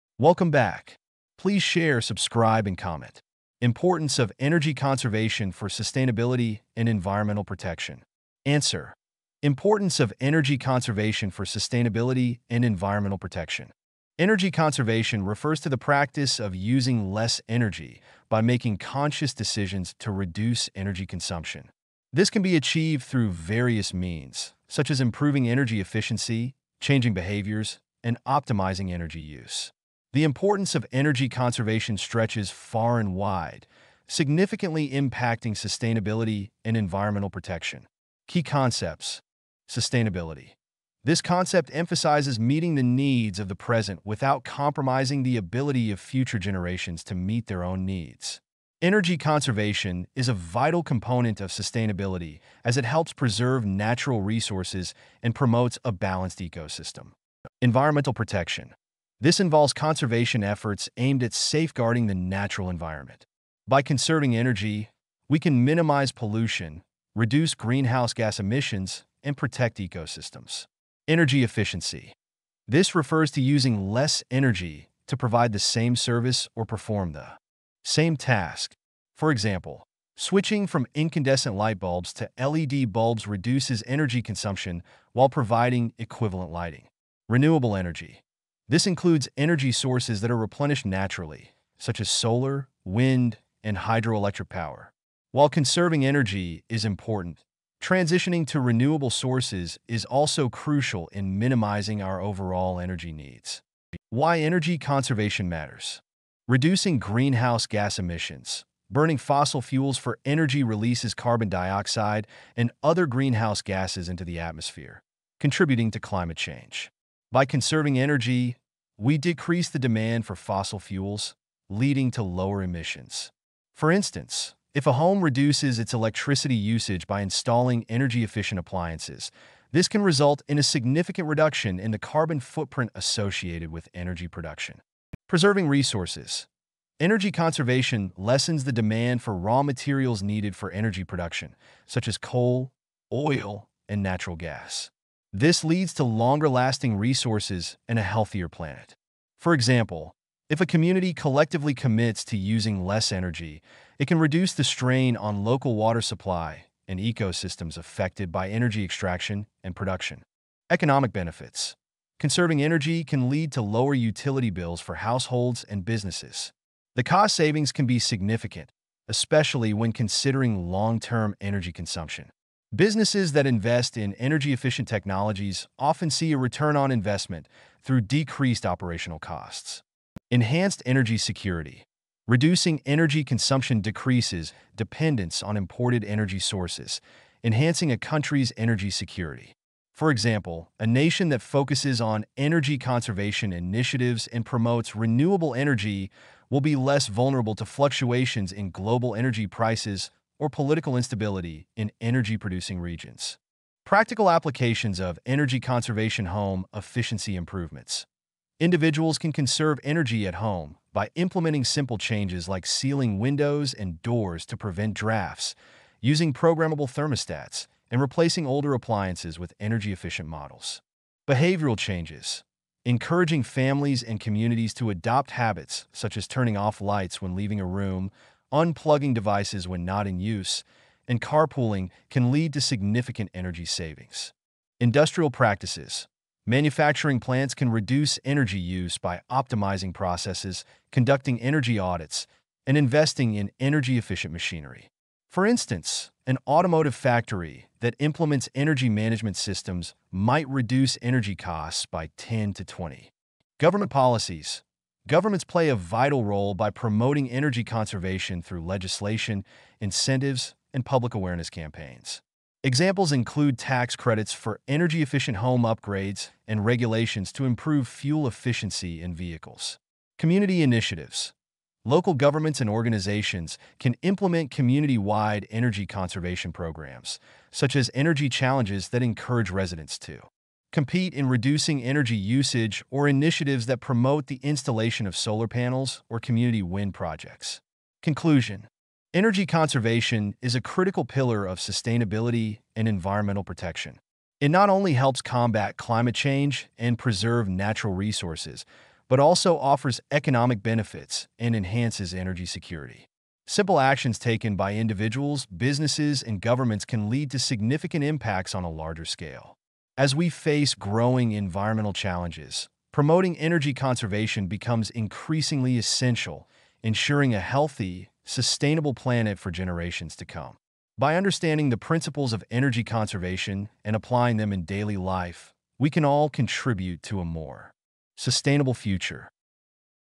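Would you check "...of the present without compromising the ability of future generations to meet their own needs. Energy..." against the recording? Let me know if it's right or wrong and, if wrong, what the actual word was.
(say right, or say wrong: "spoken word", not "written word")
right.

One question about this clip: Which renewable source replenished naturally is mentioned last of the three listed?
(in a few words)
hydroelectric power.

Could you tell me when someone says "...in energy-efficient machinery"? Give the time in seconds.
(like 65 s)
243 s.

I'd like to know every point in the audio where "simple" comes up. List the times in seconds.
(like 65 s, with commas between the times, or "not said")
211 s, 303 s.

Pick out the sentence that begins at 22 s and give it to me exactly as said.
This can be achieved through various means, such as improving energy efficiency, changing behaviors, and optimizing energy use.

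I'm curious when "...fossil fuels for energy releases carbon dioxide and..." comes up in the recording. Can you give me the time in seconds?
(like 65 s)
109 s.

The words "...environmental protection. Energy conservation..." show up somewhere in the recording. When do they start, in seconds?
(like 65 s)
12 s.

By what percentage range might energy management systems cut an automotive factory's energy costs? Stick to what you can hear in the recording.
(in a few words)
10 to 20.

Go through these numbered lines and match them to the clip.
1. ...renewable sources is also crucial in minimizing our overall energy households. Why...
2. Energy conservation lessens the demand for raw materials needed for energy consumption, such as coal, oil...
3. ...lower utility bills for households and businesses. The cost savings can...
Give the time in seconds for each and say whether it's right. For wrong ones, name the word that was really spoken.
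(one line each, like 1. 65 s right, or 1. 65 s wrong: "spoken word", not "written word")
1. 98 s wrong: "needs", not "households"
2. 136 s wrong: "production", not "consumption"
3. 163 s right.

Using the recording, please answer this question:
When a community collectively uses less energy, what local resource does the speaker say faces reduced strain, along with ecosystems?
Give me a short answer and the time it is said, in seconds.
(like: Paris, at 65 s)
water supply, at 155 s.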